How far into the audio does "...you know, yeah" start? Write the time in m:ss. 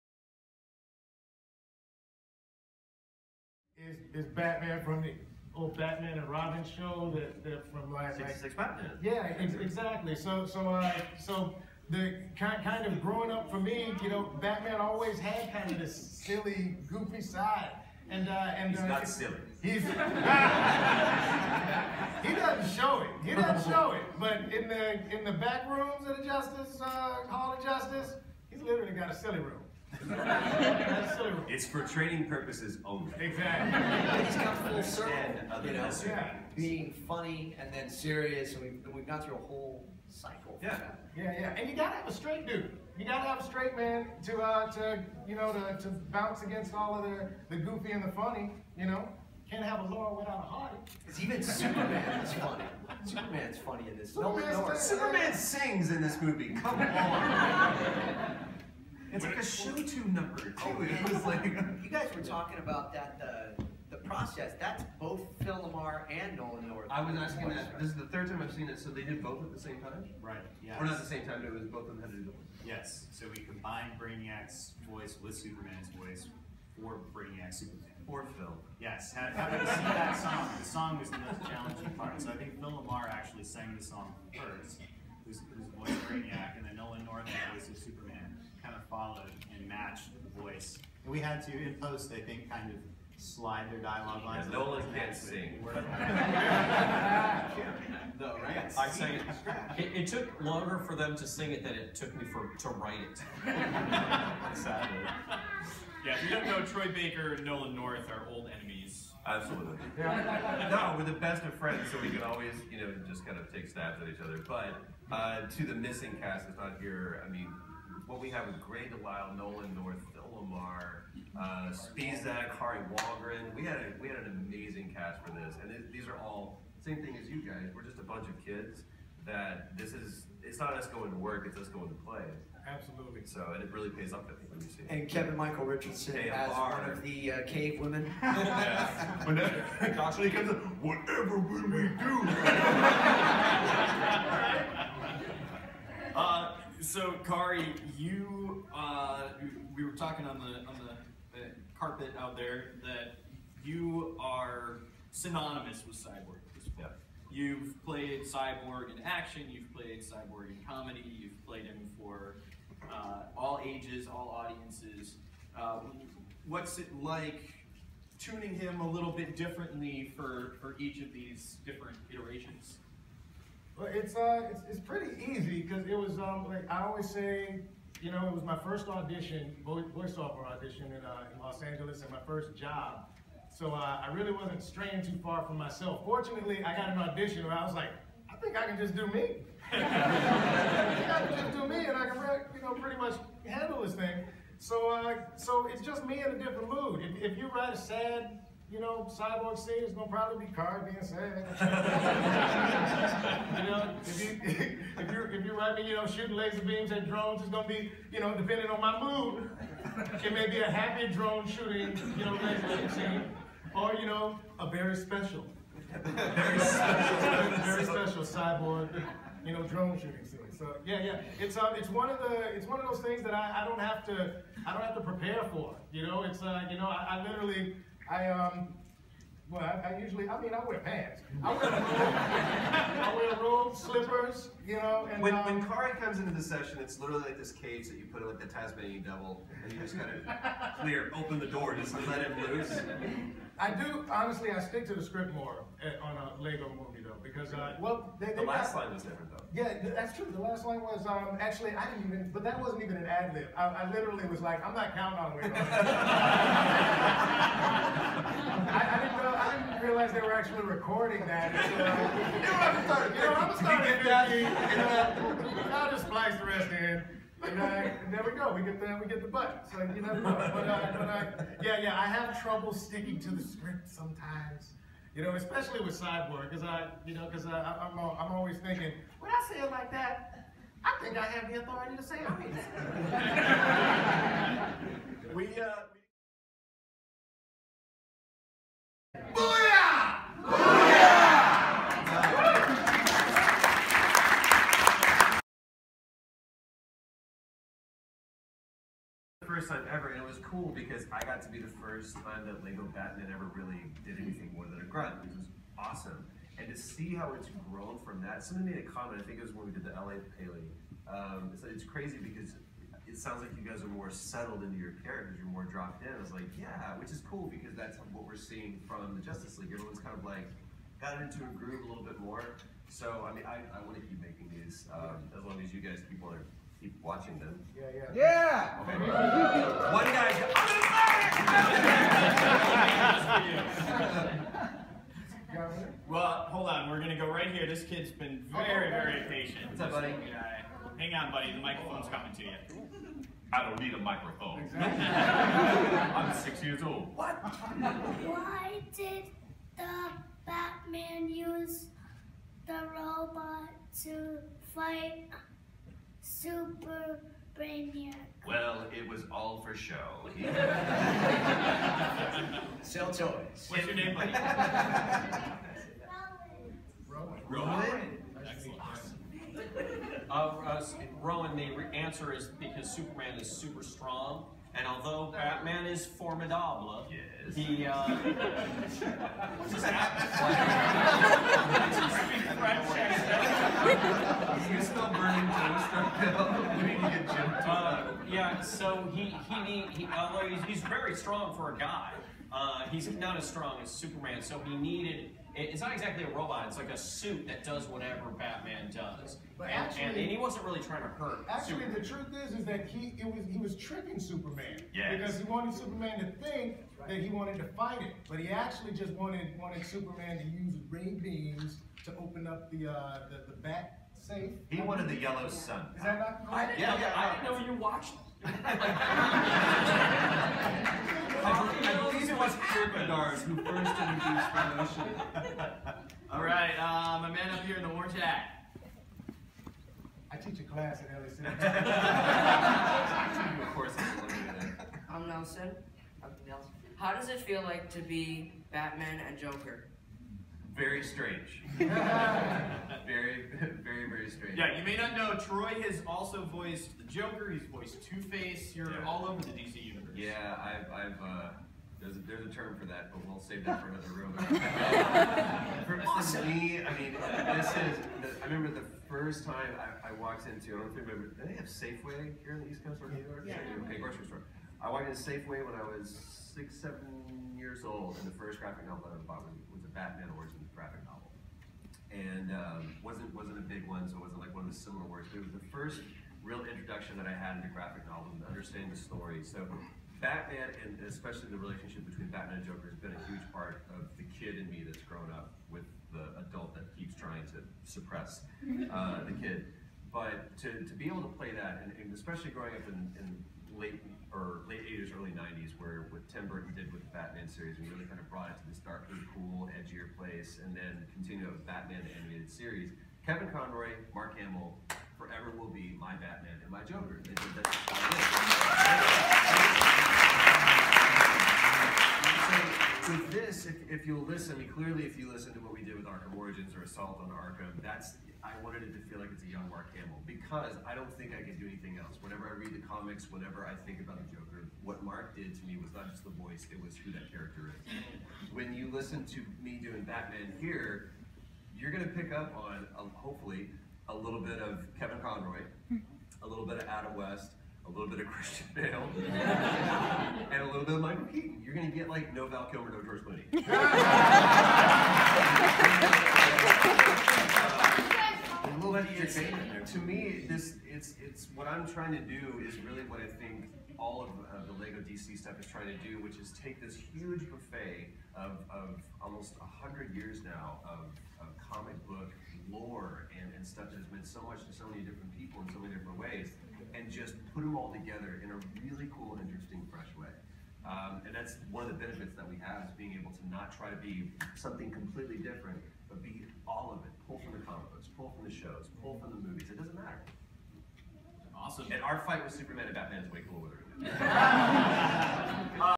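0:35.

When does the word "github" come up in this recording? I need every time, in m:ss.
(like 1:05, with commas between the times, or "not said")
not said.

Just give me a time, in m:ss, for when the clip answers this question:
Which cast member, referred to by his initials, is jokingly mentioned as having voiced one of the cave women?
2:15.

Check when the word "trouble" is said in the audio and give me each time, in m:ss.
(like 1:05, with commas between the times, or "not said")
4:32.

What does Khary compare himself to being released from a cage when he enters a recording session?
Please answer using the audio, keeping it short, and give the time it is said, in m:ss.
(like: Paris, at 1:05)
Tasmanian devil, at 3:58.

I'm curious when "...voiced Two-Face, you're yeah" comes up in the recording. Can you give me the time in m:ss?
7:27.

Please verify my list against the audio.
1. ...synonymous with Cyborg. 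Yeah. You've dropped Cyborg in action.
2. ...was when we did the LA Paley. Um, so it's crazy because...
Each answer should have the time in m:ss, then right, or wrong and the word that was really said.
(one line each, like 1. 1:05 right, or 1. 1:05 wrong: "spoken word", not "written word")
1. 2:35 wrong: "played", not "dropped"
2. 5:09 right.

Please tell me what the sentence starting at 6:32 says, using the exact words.
Uh, he's not as strong as Superman, so he needed it's not exactly a robot.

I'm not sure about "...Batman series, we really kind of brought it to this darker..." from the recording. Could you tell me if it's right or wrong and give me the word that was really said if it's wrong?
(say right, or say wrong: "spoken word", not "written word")
right.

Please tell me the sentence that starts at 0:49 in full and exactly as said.
Can't have a Laura without a heart.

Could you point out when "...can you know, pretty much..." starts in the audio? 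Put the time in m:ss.
3:12.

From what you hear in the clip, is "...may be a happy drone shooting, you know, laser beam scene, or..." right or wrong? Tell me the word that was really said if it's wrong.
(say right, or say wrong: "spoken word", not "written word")
right.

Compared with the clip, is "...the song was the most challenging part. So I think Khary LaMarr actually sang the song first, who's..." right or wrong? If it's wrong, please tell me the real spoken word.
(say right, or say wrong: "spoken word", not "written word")
wrong: "Phil", not "Khary".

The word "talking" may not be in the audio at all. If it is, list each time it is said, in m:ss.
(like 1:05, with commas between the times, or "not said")
1:02, 2:29.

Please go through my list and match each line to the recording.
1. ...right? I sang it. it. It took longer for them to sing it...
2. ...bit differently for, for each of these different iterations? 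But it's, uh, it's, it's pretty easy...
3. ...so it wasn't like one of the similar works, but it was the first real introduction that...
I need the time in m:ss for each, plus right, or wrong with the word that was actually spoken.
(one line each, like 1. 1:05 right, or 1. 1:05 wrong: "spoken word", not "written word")
1. 1:38 right
2. 2:49 right
3. 7:54 right.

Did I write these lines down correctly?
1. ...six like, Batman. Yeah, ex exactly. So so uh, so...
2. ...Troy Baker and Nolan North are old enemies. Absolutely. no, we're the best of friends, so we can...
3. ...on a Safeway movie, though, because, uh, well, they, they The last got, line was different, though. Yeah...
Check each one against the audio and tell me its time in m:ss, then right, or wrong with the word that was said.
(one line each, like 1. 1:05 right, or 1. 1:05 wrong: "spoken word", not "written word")
1. 0:08 right
2. 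1:46 right
3. 4:06 wrong: "Lego", not "Safeway".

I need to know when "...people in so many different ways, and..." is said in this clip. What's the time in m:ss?
9:25.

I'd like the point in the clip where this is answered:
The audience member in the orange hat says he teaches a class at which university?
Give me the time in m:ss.
7:11.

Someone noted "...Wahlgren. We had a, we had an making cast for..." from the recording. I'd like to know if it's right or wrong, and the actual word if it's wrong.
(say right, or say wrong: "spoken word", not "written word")
wrong: "amazing", not "making".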